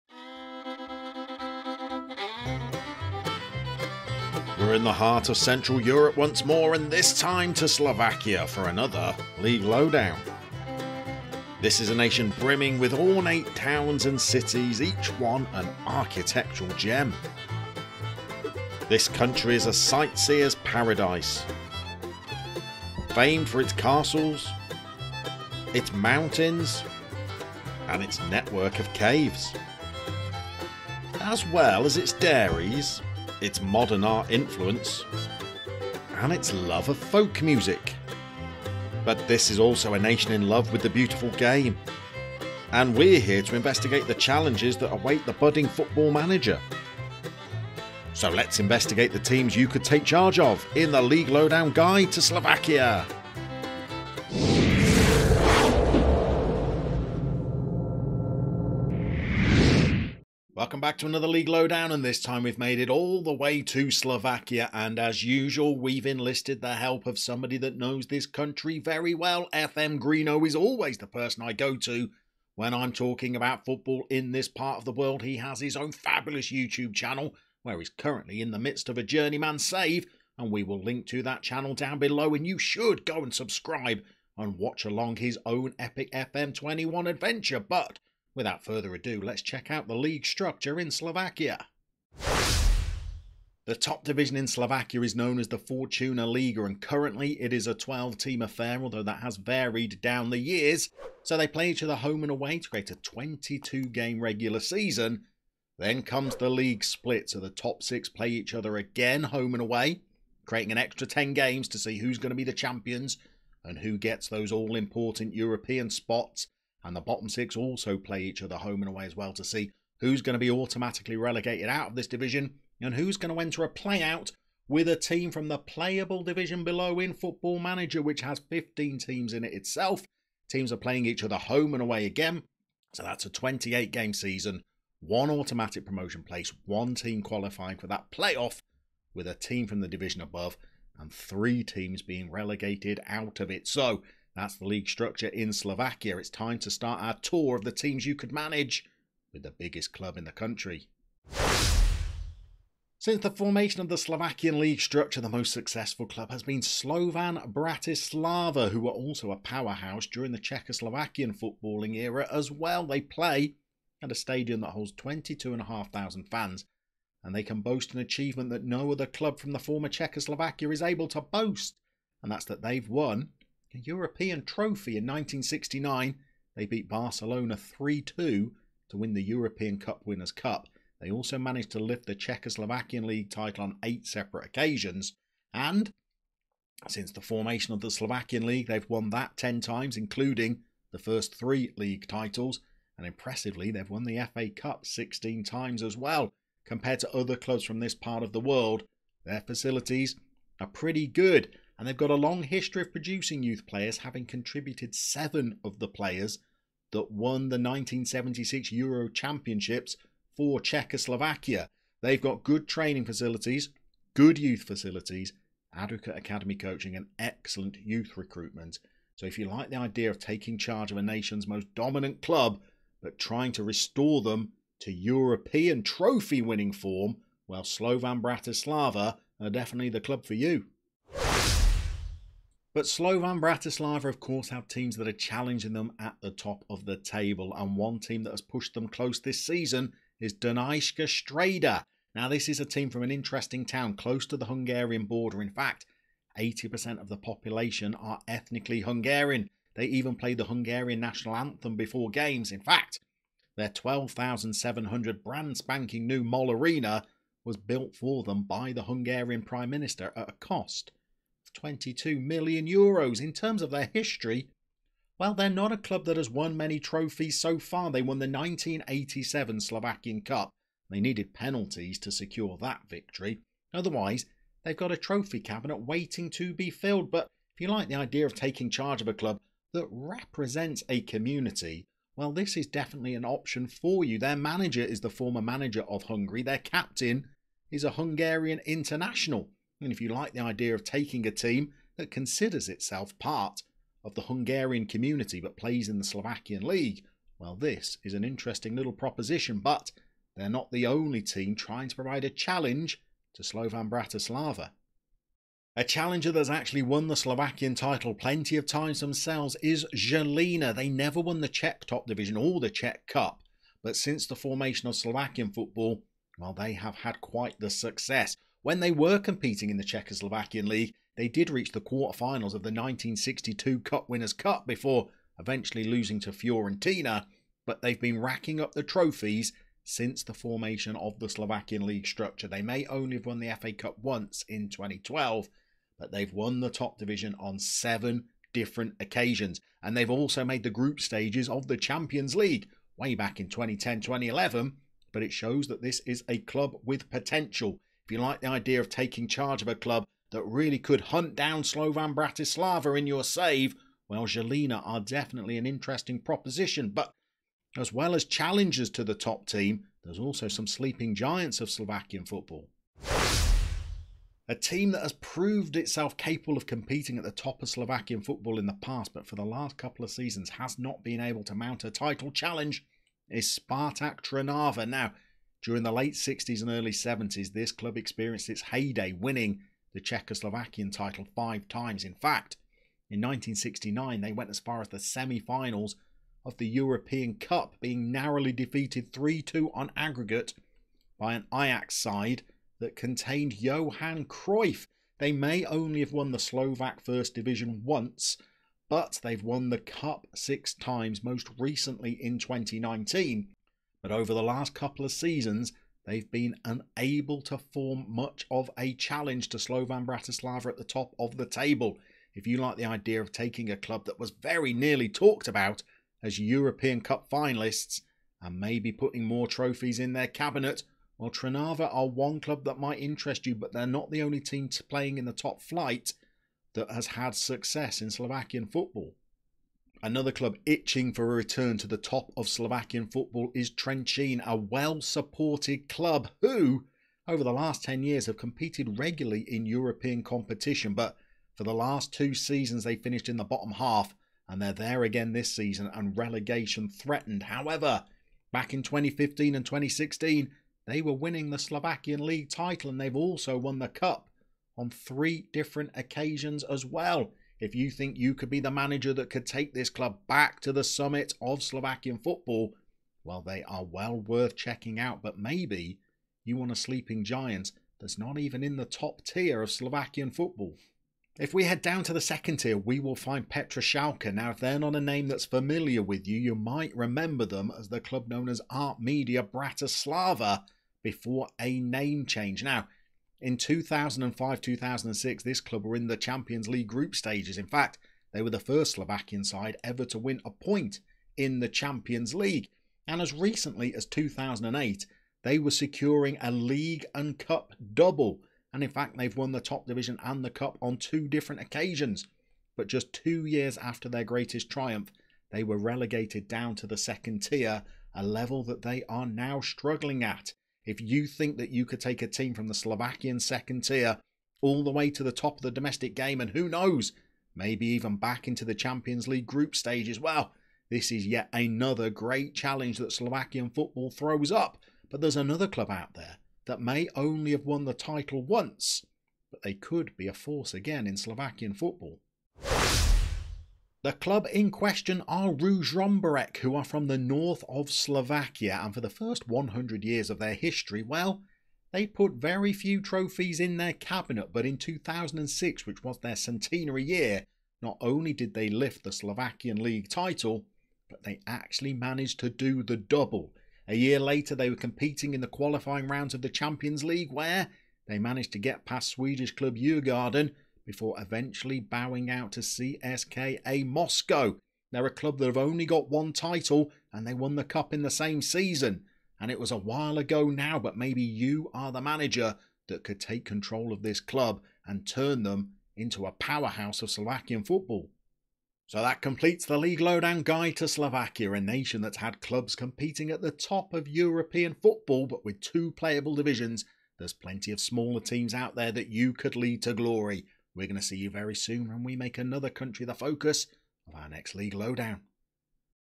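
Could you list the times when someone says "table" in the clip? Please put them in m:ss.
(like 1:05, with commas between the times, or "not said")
3:56, 6:51.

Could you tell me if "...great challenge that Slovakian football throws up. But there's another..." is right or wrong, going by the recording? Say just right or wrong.
right.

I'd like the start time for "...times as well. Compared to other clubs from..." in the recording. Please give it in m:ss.
3:15.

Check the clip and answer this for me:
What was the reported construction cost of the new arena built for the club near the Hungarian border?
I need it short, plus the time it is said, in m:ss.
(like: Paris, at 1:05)
22 million euros, at 4:21.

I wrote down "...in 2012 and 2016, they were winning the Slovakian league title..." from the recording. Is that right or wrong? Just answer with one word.
wrong.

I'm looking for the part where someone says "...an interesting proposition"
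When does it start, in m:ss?
5:55.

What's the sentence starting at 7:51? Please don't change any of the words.
If we head down to the second tier, we will find Petržalka.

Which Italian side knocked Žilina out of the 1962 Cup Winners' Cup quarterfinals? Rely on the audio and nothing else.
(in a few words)
Fiorentina.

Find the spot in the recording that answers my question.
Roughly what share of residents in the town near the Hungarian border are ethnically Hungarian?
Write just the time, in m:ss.
4:06.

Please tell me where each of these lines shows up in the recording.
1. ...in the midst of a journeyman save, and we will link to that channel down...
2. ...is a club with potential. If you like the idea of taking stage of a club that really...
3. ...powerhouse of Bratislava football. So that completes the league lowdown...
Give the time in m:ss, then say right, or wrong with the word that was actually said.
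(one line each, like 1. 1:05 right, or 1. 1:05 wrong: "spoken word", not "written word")
1. 1:18 right
2. 5:46 wrong: "charge", not "stage"
3. 9:36 wrong: "Slovakian", not "Bratislava".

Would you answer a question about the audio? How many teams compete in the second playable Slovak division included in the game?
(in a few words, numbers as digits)
15.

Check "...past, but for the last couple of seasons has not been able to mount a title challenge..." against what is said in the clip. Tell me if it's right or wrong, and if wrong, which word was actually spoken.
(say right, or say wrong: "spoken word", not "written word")
right.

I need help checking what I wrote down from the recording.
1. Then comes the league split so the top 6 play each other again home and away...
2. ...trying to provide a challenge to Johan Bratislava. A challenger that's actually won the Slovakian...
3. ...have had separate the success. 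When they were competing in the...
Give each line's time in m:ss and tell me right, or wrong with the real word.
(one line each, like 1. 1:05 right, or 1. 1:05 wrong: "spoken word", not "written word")
1. 1:45 right
2. 5:01 wrong: "Slovan", not "Johan"
3. 5:16 wrong: "quite", not "separate".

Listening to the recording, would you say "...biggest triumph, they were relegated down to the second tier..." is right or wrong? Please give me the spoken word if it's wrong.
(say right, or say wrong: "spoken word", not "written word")
wrong: "greatest", not "biggest".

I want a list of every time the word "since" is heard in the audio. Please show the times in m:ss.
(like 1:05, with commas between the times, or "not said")
2:32, 3:06, 5:13, 5:29.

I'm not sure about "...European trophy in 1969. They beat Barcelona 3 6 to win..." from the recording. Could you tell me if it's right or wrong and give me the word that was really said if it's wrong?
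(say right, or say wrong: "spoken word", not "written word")
wrong: "2", not "6".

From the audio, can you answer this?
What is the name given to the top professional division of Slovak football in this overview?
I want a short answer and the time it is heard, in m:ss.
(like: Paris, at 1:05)
Fortuna Liga, at 1:35.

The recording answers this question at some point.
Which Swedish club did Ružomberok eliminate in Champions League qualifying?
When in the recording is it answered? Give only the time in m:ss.
9:19.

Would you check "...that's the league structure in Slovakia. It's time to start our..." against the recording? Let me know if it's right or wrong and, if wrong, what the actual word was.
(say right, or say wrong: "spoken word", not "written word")
right.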